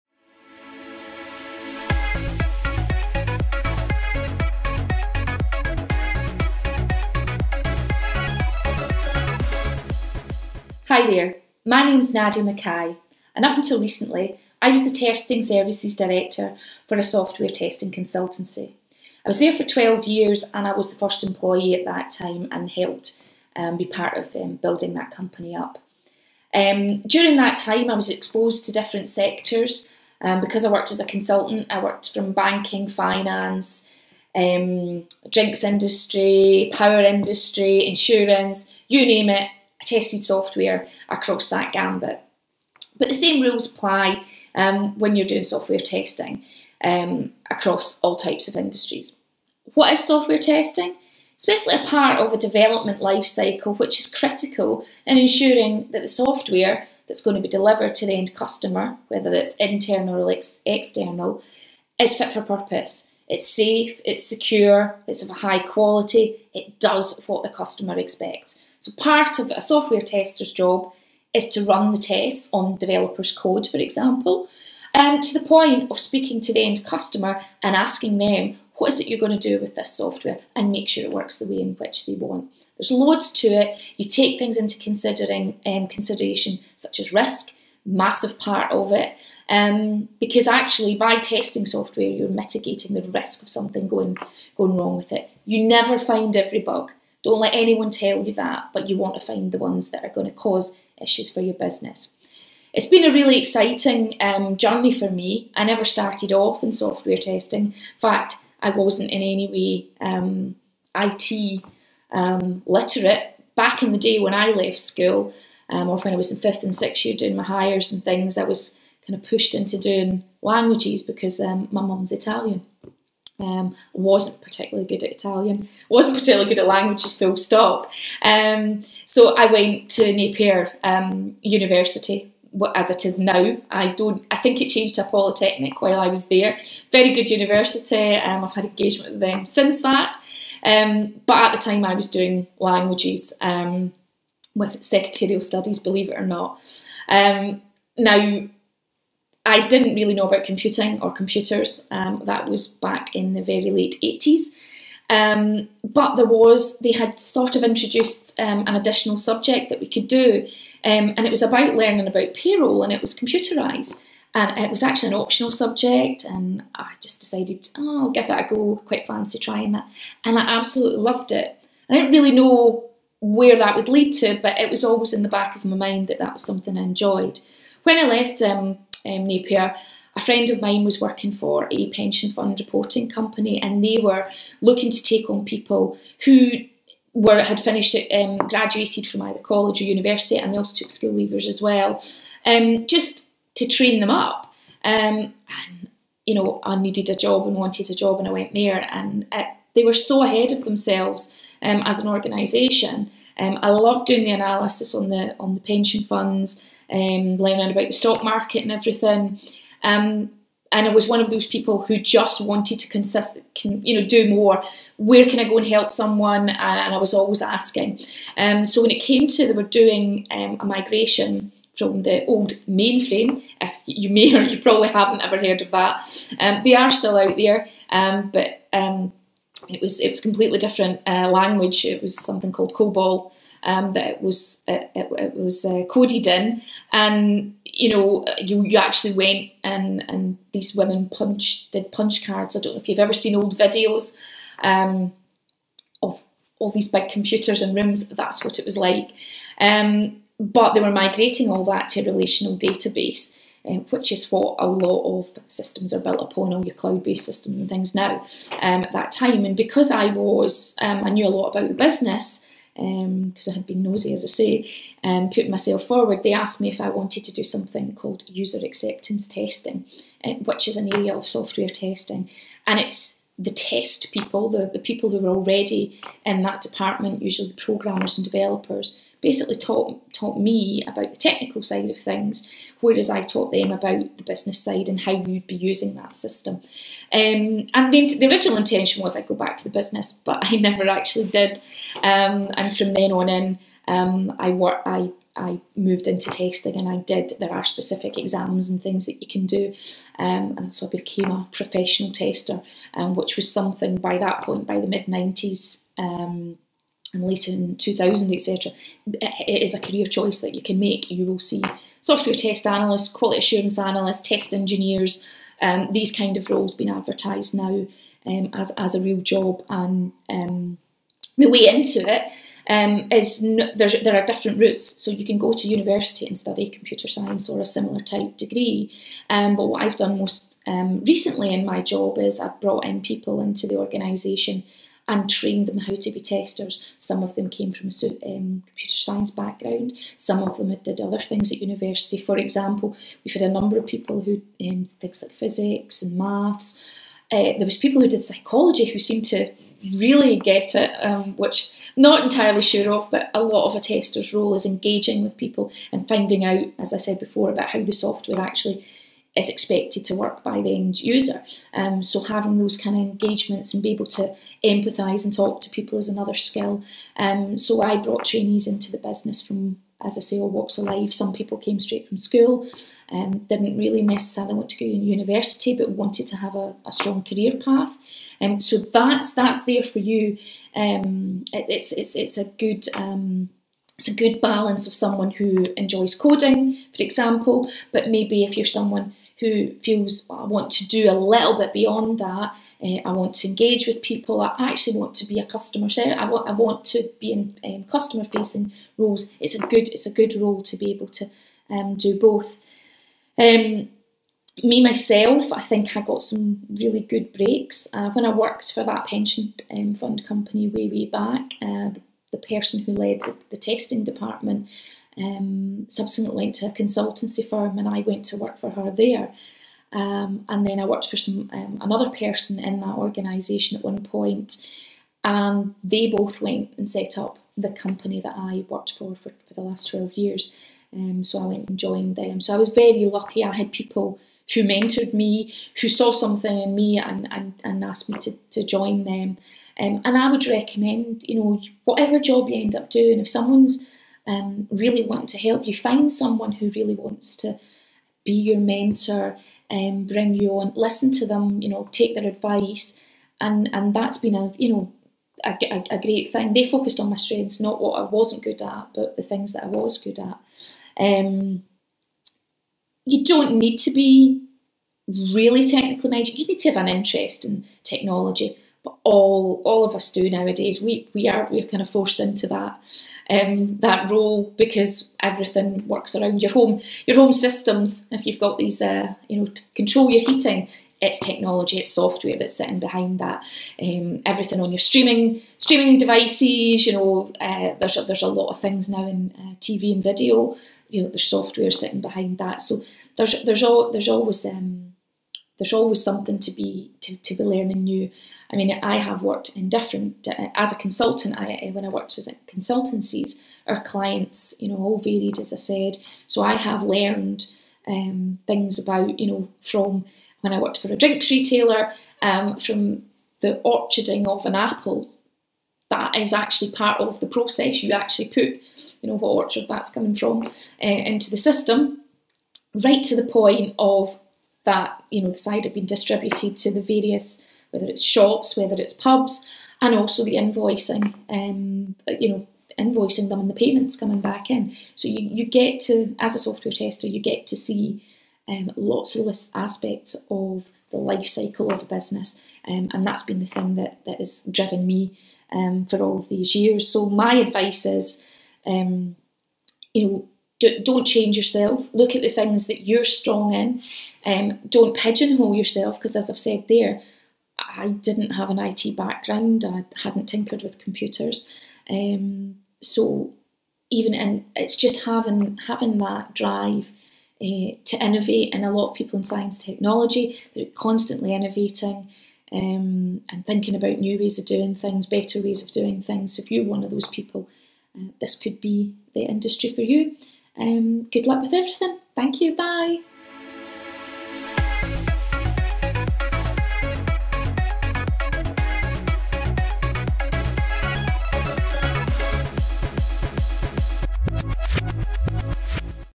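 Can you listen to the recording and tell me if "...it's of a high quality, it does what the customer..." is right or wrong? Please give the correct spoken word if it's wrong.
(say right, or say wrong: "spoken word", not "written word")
right.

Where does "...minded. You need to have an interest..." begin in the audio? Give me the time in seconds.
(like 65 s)
466 s.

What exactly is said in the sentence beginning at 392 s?
Uh, I want to engage with people.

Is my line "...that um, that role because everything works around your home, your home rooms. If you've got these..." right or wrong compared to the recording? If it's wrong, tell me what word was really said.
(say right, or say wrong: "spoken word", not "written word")
wrong: "systems", not "rooms".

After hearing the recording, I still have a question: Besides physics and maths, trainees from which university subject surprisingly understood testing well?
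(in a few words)
Psychology.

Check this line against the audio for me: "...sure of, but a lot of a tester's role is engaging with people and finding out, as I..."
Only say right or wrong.
right.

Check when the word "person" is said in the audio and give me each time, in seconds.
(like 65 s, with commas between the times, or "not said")
412 s, 422 s.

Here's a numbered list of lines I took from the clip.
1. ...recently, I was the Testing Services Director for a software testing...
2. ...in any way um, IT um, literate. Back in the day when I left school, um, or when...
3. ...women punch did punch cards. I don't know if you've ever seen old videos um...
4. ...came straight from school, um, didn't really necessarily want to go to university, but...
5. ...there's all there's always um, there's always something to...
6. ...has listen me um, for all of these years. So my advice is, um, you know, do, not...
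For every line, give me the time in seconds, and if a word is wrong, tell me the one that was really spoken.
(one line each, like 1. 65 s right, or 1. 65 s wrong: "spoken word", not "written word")
1. 13 s right
2. 109 s right
3. 240 s right
4. 371 s right
5. 493 s right
6. 544 s wrong: "driven", not "listen".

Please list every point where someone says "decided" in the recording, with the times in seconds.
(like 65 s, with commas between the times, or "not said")
167 s.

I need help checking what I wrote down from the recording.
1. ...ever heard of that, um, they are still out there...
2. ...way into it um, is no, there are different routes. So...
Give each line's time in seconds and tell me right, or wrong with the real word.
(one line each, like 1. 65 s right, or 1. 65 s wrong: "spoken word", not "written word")
1. 225 s right
2. 321 s right.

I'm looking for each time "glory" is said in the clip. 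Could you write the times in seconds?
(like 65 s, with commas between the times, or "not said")
not said.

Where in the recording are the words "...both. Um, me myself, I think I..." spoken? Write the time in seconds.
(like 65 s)
402 s.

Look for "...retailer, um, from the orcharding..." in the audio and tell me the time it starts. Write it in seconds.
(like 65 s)
511 s.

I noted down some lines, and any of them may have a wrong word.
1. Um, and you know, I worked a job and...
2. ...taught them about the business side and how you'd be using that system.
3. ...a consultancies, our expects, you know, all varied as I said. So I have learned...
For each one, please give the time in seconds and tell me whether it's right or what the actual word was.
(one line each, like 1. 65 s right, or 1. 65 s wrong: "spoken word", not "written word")
1. 194 s wrong: "needed", not "worked"
2. 283 s right
3. 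502 s wrong: "clients", not "expects".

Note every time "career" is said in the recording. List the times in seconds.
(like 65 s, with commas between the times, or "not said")
309 s, 377 s.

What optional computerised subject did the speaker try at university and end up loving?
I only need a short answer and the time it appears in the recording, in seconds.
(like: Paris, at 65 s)
Payroll, at 162 s.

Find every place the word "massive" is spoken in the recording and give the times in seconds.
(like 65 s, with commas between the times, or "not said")
87 s.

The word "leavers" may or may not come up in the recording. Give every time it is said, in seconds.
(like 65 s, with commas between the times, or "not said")
191 s.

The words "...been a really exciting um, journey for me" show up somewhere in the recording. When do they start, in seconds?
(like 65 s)
102 s.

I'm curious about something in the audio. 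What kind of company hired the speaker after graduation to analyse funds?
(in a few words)
Pension fund reporting company.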